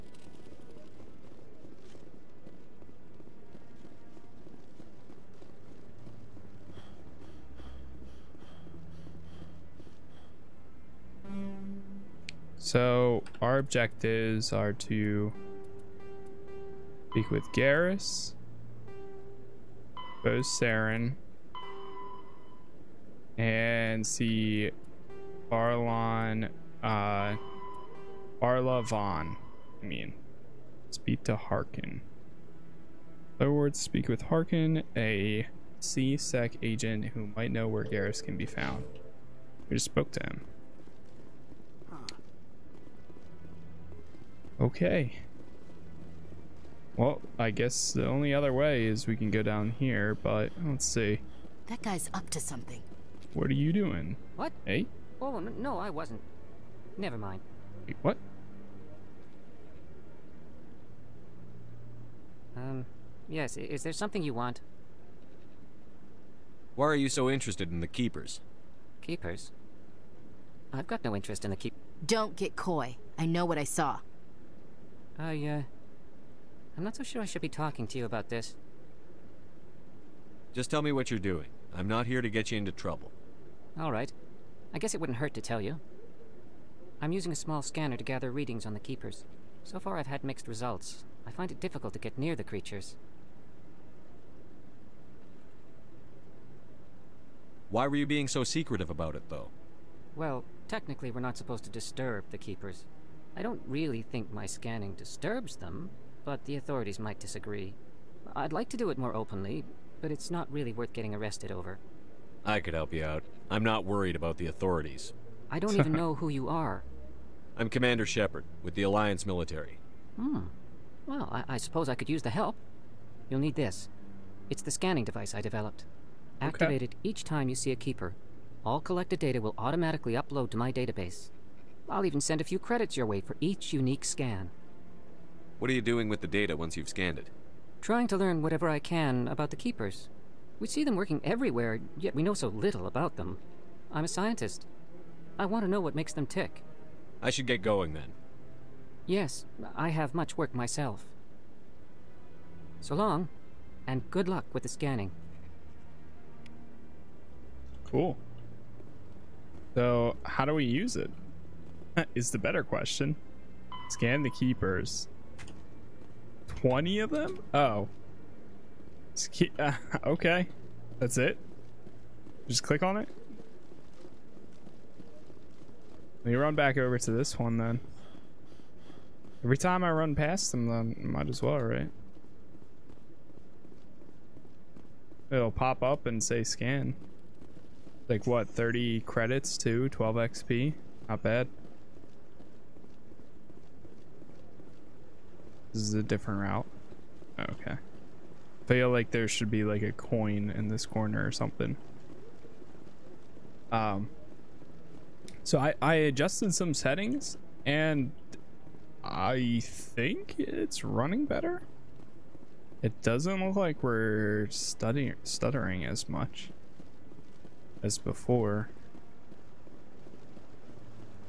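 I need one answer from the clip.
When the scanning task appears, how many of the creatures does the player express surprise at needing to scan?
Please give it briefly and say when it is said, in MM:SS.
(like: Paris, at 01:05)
20, at 02:46.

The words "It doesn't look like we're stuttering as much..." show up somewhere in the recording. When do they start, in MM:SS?
03:32.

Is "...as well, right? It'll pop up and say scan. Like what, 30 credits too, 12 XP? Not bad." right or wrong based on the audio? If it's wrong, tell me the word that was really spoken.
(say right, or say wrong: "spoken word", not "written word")
right.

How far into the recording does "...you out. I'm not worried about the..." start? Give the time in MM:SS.
01:52.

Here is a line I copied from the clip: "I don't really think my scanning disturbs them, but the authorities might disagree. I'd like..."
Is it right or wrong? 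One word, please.
right.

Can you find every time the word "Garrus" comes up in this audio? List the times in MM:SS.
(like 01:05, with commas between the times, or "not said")
00:17, 00:37.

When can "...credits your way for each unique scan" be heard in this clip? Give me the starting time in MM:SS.
02:12.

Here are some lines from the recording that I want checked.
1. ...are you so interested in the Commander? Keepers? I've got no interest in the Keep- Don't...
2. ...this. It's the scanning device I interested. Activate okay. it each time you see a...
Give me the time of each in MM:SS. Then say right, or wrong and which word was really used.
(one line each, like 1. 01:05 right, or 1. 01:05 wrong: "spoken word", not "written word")
1. 01:06 wrong: "Keepers", not "Commander"
2. 02:03 wrong: "developed", not "interested".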